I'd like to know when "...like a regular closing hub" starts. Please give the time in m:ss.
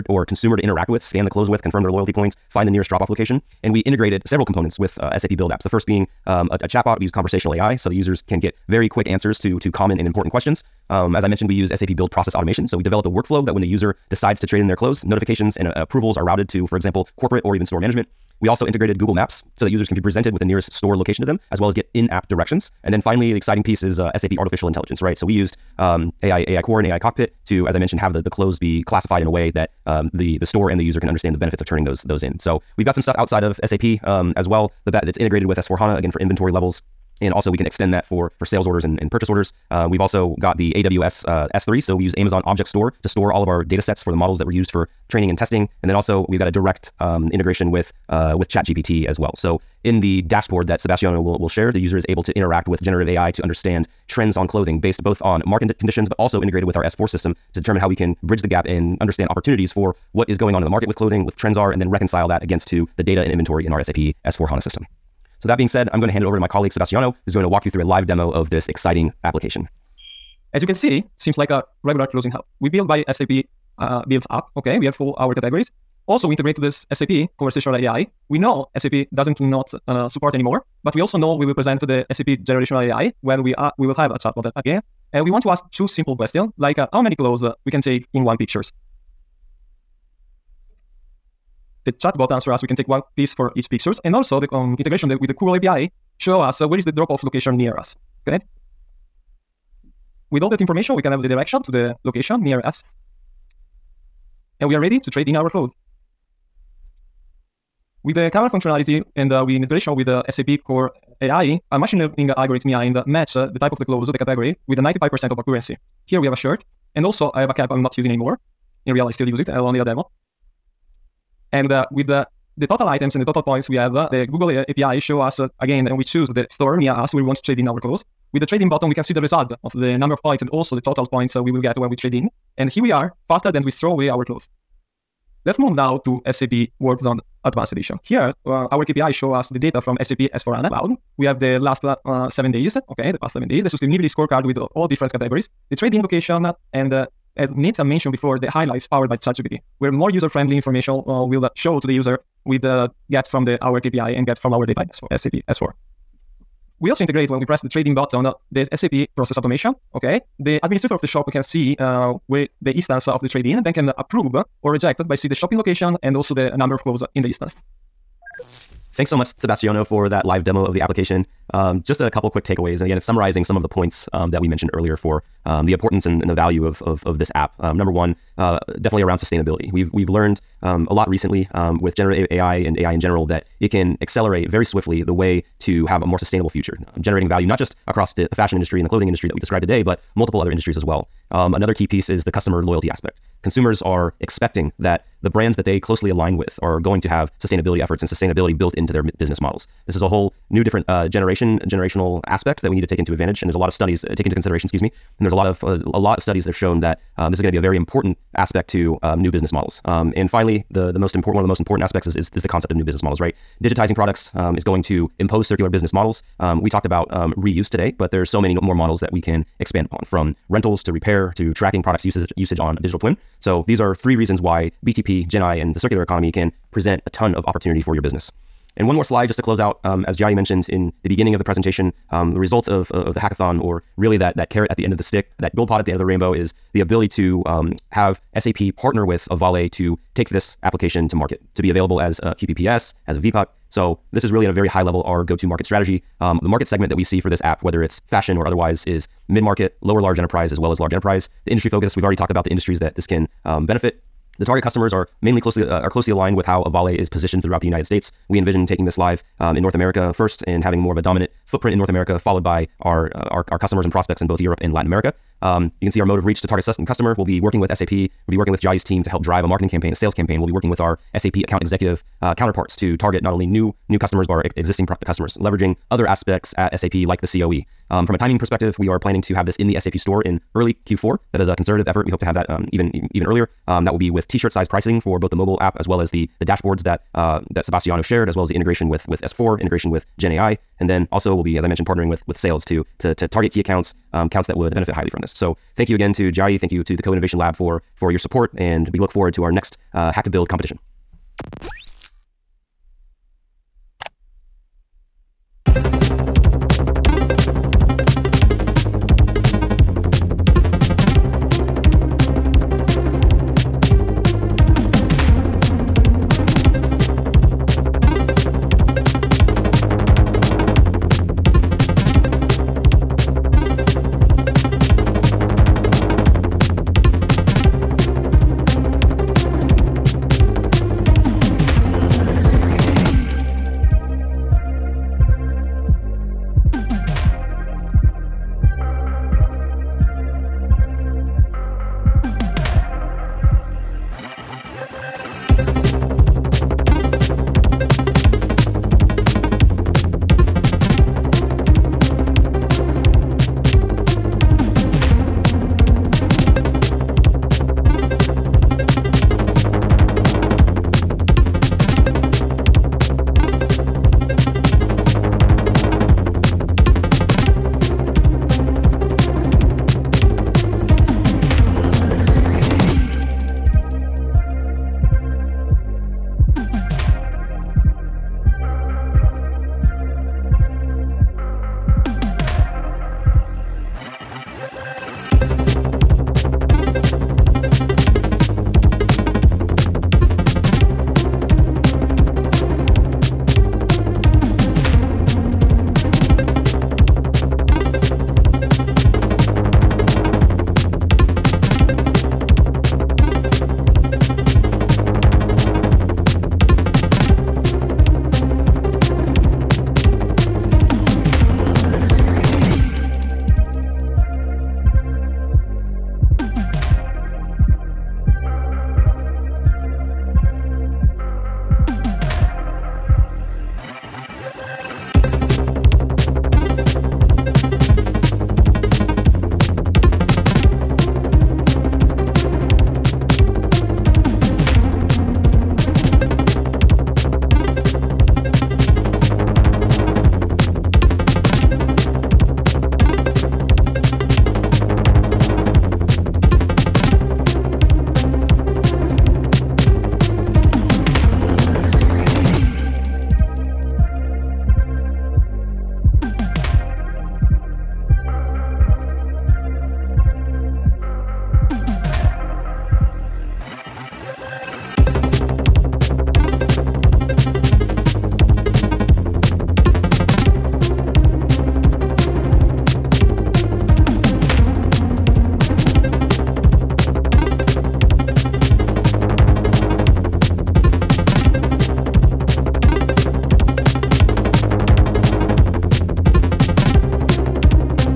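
1:11.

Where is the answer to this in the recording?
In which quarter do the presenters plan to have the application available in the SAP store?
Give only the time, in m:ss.
4:40.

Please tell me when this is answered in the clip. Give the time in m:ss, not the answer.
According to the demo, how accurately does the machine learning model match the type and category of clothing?
1:54.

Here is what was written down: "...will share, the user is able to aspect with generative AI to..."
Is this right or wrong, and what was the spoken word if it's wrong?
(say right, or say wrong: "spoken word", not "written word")
wrong: "interact", not "aspect".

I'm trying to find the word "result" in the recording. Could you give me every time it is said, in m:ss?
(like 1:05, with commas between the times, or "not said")
2:09, 3:52.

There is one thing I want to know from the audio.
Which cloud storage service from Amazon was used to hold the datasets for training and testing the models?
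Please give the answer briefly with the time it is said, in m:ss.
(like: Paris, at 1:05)
AWS S3, at 0:40.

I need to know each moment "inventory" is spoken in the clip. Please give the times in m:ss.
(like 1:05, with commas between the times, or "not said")
0:36, 1:03.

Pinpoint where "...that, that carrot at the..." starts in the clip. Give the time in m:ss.
3:54.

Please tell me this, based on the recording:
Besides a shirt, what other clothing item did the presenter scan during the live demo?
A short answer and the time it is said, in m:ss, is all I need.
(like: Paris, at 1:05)
A cap, at 1:57.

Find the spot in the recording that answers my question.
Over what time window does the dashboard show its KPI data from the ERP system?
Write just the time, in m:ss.
2:23.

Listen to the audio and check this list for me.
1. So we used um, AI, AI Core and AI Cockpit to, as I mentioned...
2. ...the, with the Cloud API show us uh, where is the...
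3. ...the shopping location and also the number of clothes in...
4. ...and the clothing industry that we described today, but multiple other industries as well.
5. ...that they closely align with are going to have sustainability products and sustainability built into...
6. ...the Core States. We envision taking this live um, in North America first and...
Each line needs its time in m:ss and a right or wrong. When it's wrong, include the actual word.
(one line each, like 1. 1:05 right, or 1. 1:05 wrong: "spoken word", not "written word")
1. 0:25 right
2. 1:35 wrong: "Google", not "Cloud"
3. 2:45 right
4. 3:08 right
5. 3:15 wrong: "efforts", not "products"
6. 4:17 wrong: "United", not "Core".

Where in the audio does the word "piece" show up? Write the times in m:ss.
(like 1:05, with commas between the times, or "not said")
0:23, 1:33, 3:11.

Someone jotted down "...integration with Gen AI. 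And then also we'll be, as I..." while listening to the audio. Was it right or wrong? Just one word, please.
right.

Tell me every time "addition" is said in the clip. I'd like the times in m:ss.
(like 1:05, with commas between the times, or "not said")
not said.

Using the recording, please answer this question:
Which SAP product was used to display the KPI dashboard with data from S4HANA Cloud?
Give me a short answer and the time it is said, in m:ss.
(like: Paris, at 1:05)
SAP Zone Advanced Edition, at 2:16.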